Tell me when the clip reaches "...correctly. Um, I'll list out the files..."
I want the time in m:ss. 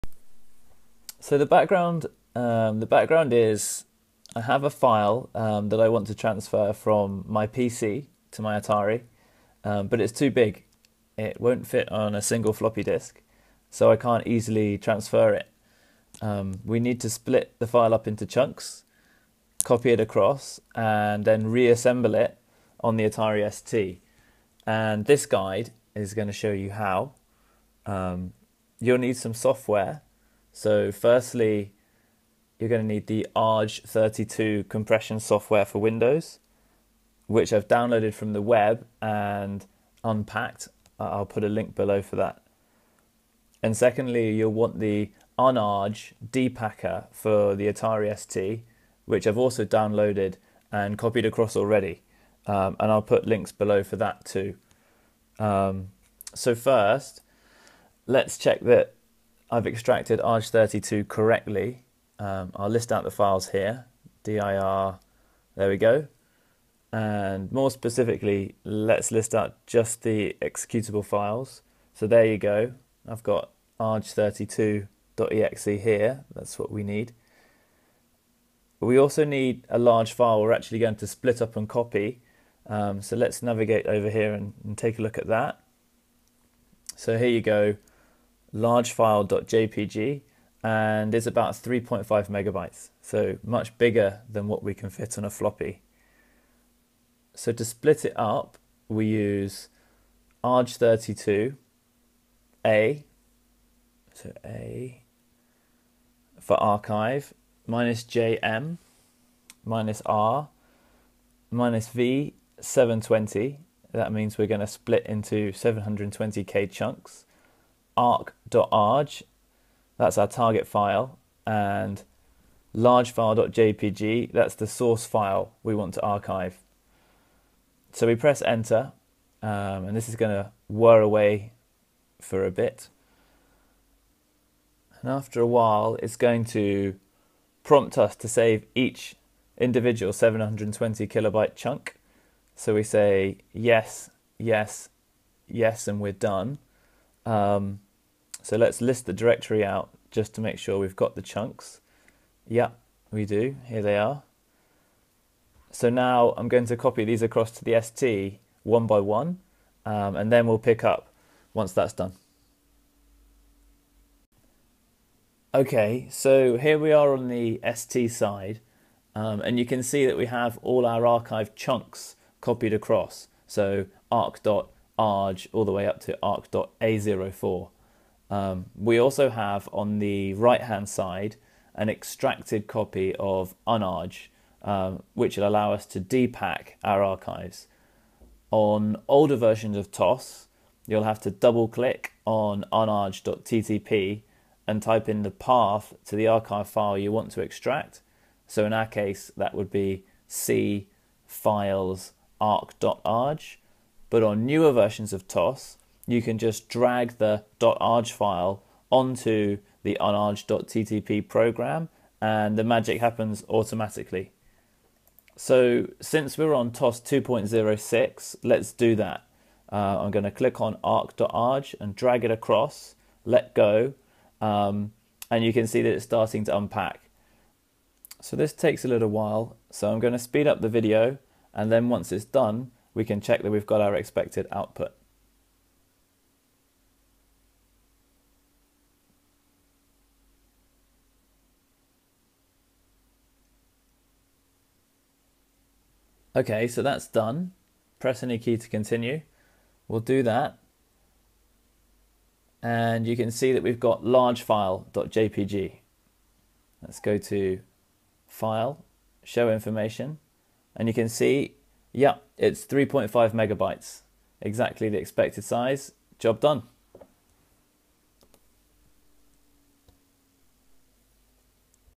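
1:01.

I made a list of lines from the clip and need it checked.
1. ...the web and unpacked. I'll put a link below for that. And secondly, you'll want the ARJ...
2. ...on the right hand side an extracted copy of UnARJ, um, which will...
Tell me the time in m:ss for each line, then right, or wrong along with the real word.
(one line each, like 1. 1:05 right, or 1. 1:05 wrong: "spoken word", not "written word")
1. 0:38 wrong: "UnARJ", not "ARJ"
2. 2:59 right.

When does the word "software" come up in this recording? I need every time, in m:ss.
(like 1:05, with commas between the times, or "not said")
0:29, 0:35.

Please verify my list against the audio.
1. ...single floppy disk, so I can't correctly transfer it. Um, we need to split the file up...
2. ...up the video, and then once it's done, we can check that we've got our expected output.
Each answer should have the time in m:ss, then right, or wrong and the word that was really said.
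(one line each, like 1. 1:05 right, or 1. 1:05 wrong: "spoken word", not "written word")
1. 0:12 wrong: "easily", not "correctly"
2. 3:50 right.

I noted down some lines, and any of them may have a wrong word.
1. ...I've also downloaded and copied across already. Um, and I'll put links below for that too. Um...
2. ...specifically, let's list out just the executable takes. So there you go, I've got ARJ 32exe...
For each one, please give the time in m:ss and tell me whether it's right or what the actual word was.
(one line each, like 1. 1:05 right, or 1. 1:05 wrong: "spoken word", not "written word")
1. 0:49 right
2. 1:07 wrong: "files", not "takes".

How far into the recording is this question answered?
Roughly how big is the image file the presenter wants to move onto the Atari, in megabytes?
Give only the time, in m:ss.
1:31.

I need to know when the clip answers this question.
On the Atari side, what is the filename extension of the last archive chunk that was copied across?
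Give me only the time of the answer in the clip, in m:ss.
2:56.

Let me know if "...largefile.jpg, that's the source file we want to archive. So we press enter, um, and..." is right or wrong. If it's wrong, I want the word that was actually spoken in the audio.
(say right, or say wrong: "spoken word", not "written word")
right.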